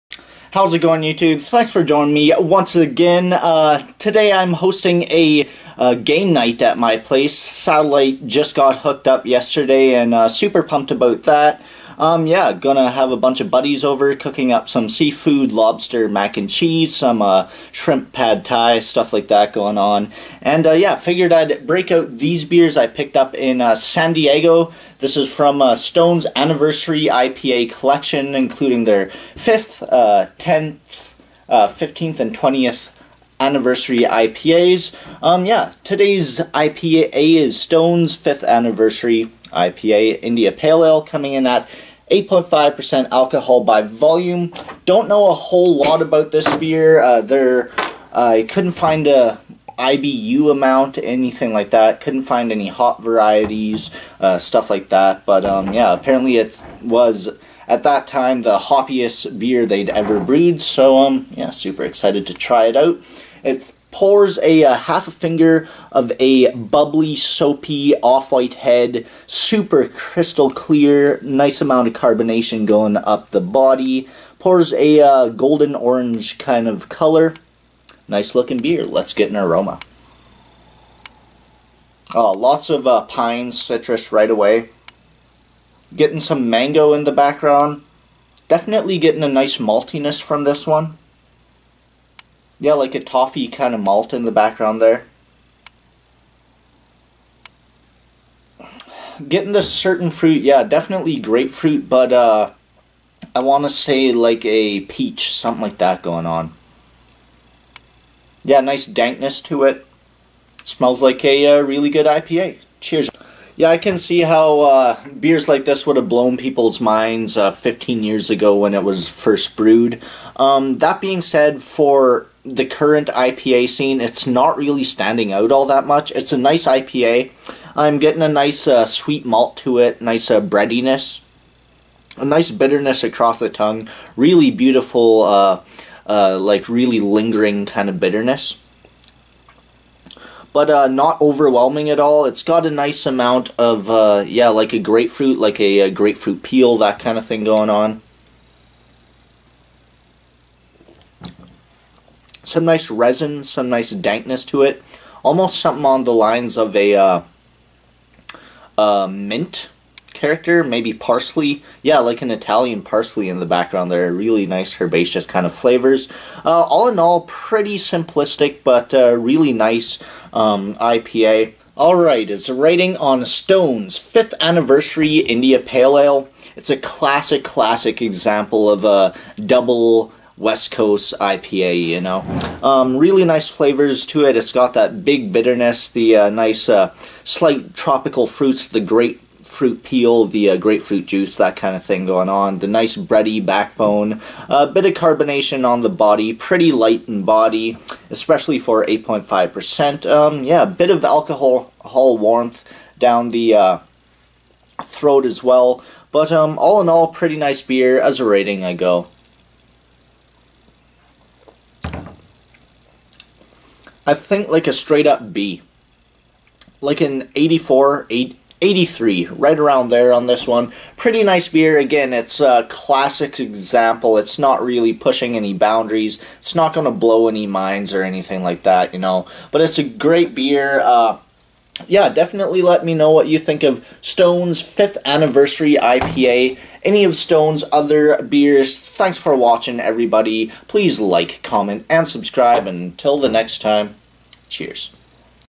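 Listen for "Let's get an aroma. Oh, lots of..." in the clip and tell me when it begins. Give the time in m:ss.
1:18.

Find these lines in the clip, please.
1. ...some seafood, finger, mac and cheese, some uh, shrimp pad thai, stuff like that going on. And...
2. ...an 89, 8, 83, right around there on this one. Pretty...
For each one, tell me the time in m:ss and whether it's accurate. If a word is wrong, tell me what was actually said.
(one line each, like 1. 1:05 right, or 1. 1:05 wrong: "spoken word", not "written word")
1. 0:14 wrong: "lobster", not "finger"
2. 3:36 wrong: "84", not "89".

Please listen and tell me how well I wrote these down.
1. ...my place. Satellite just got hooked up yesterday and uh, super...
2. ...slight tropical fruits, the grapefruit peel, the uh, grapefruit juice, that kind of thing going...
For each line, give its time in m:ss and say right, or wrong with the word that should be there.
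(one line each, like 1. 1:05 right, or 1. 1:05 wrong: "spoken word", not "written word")
1. 0:06 right
2. 3:07 right.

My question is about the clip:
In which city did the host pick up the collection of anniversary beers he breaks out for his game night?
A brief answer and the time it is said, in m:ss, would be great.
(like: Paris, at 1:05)
San Diego, at 0:23.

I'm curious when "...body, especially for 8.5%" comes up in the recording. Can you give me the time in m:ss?
3:17.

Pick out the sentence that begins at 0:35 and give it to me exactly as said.
Um, yeah, today's IPA is Stone's 5th anniversary IPA India Pale Ale coming in at 8.5% alcohol by volume.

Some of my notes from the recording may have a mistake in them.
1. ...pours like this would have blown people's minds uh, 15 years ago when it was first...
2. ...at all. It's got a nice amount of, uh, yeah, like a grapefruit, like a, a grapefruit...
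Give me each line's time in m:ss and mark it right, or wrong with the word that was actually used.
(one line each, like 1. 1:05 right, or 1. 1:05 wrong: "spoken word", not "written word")
1. 1:55 wrong: "beers", not "pours"
2. 2:21 right.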